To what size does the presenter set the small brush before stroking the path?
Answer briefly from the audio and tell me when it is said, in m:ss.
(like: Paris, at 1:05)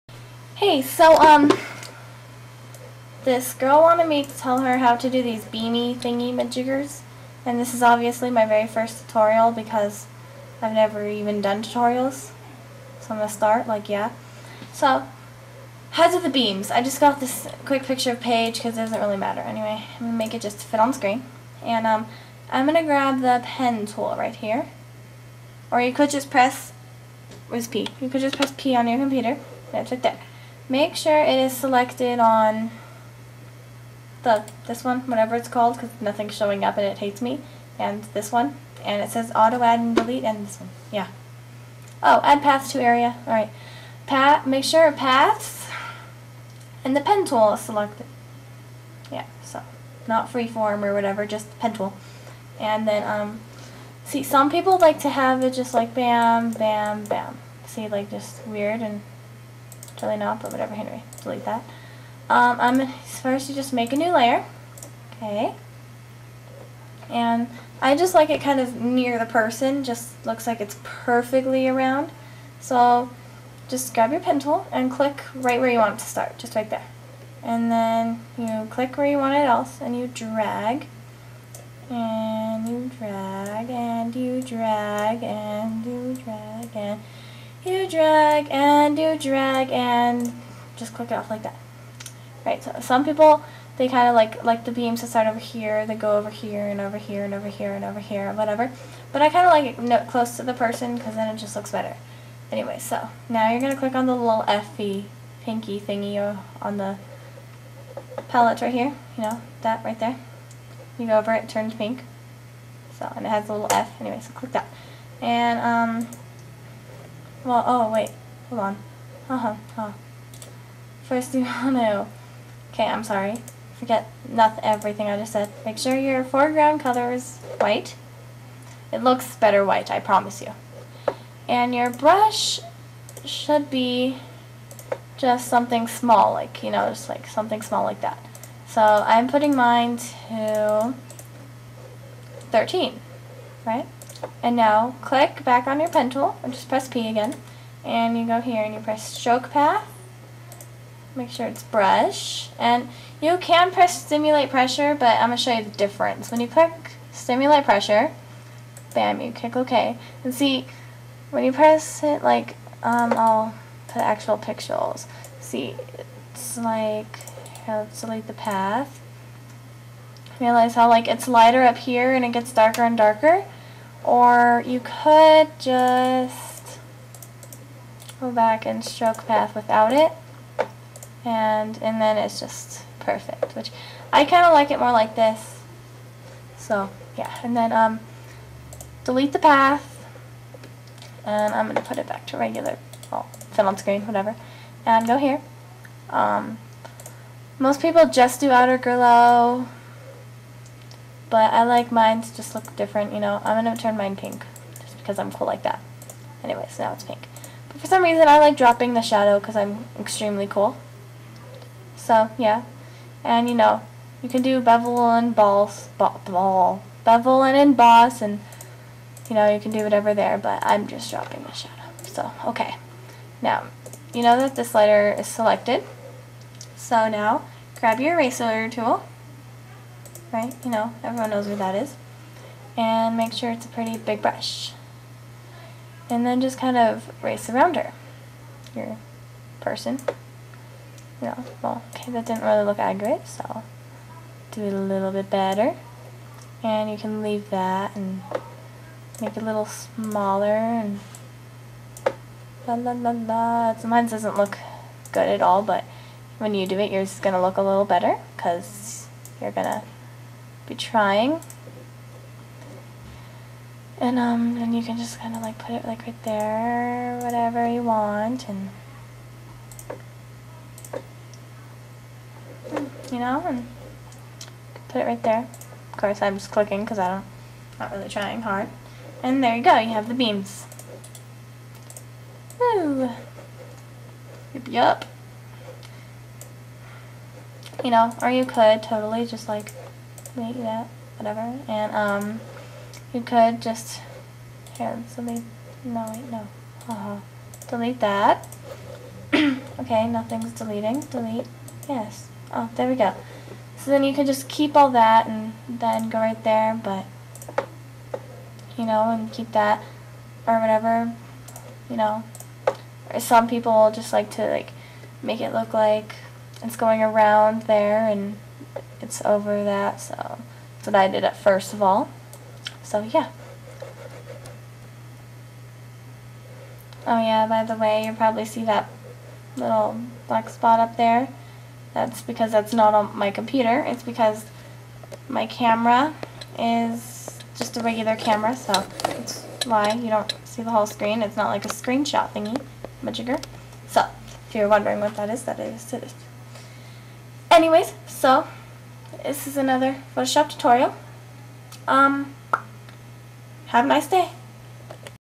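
13, at 2:22.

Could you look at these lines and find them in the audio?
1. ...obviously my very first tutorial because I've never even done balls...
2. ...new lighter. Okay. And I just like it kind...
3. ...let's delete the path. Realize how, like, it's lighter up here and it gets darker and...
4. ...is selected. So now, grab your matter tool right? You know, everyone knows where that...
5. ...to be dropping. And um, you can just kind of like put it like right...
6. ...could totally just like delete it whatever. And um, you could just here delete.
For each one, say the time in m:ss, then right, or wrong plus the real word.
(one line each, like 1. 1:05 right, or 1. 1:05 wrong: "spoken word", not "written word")
1. 0:07 wrong: "tutorials", not "balls"
2. 1:03 wrong: "layer", not "lighter"
3. 2:47 right
4. 3:45 wrong: "eraser", not "matter"
5. 4:19 wrong: "trying", not "dropping"
6. 4:48 right.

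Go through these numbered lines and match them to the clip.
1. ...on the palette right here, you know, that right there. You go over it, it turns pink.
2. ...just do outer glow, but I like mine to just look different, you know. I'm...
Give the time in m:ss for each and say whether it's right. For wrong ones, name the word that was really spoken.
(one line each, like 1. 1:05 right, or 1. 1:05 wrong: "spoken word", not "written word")
1. 1:46 right
2. 3:18 right.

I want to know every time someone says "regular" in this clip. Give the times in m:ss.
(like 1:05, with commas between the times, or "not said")
3:12, 5:37.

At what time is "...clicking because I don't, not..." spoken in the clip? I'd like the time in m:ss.
4:36.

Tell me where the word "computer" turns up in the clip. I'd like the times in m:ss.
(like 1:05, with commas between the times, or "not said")
0:28, 5:33.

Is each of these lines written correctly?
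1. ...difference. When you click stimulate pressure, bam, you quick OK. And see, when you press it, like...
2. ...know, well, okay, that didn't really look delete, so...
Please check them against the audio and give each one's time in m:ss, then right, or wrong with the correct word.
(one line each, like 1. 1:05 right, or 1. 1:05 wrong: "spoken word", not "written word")
1. 2:35 wrong: "click", not "quick"
2. 4:01 wrong: "accurate", not "delete".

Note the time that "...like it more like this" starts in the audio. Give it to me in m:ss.
3:04.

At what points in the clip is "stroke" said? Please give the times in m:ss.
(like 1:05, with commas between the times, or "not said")
2:29, 2:58.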